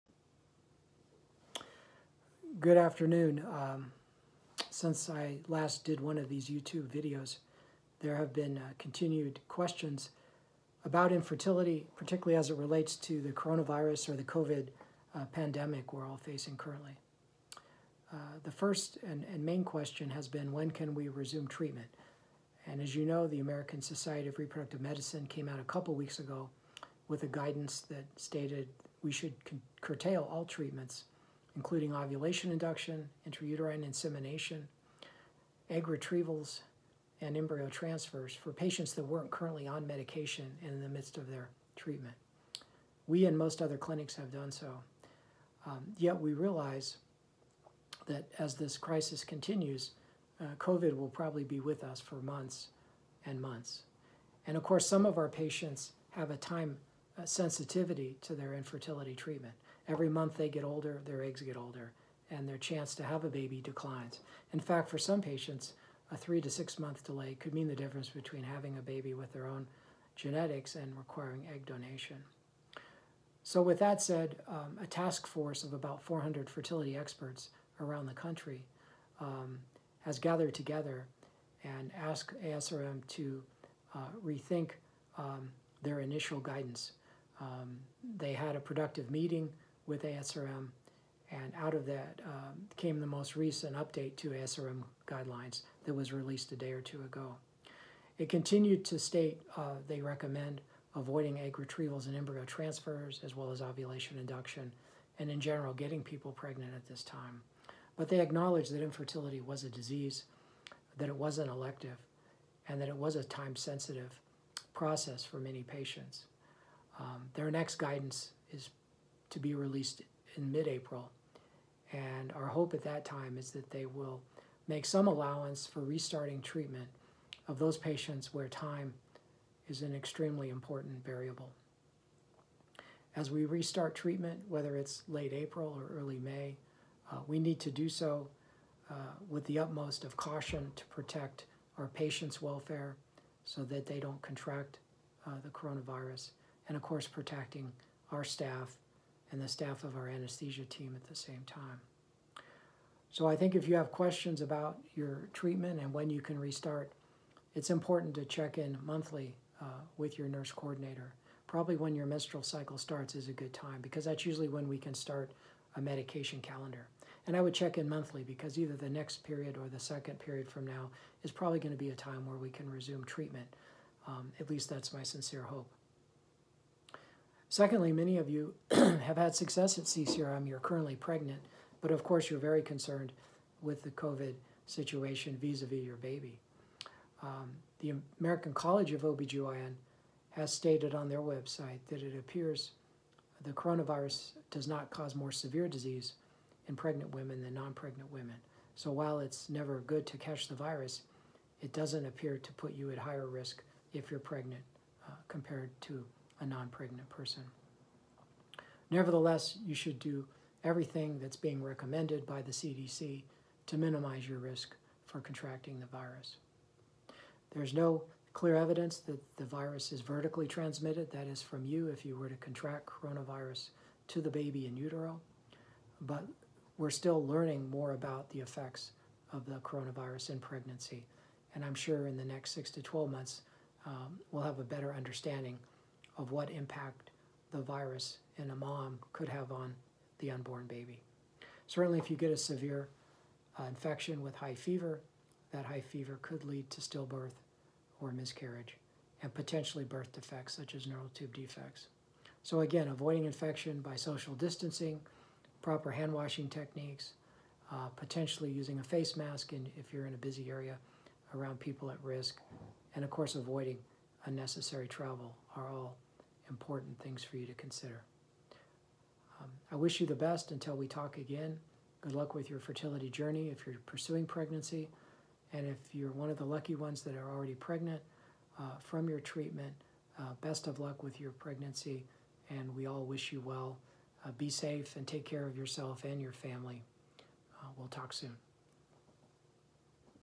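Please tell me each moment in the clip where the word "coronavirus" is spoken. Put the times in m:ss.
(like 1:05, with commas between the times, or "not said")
0:13, 2:25, 3:13, 3:42, 3:49.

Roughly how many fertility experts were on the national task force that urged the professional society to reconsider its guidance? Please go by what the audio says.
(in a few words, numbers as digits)
400.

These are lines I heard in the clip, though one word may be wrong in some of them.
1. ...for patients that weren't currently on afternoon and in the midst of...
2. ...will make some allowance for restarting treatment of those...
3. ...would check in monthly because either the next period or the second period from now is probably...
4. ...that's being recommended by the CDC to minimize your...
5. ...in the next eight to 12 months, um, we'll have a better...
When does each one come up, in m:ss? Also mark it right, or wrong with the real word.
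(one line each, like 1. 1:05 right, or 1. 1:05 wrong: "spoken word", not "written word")
1. 0:38 wrong: "medication", not "afternoon"
2. 2:03 right
3. 2:47 right
4. 3:31 right
5. 3:52 wrong: "six", not "eight".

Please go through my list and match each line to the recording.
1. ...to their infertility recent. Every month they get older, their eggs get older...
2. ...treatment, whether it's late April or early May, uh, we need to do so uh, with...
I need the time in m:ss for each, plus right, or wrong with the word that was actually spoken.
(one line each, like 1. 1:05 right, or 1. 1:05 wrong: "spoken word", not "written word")
1. 0:58 wrong: "treatment", not "recent"
2. 2:13 right.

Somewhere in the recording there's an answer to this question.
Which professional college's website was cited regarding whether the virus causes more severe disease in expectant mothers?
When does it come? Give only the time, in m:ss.
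3:08.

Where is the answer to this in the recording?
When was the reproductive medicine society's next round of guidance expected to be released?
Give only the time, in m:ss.
2:00.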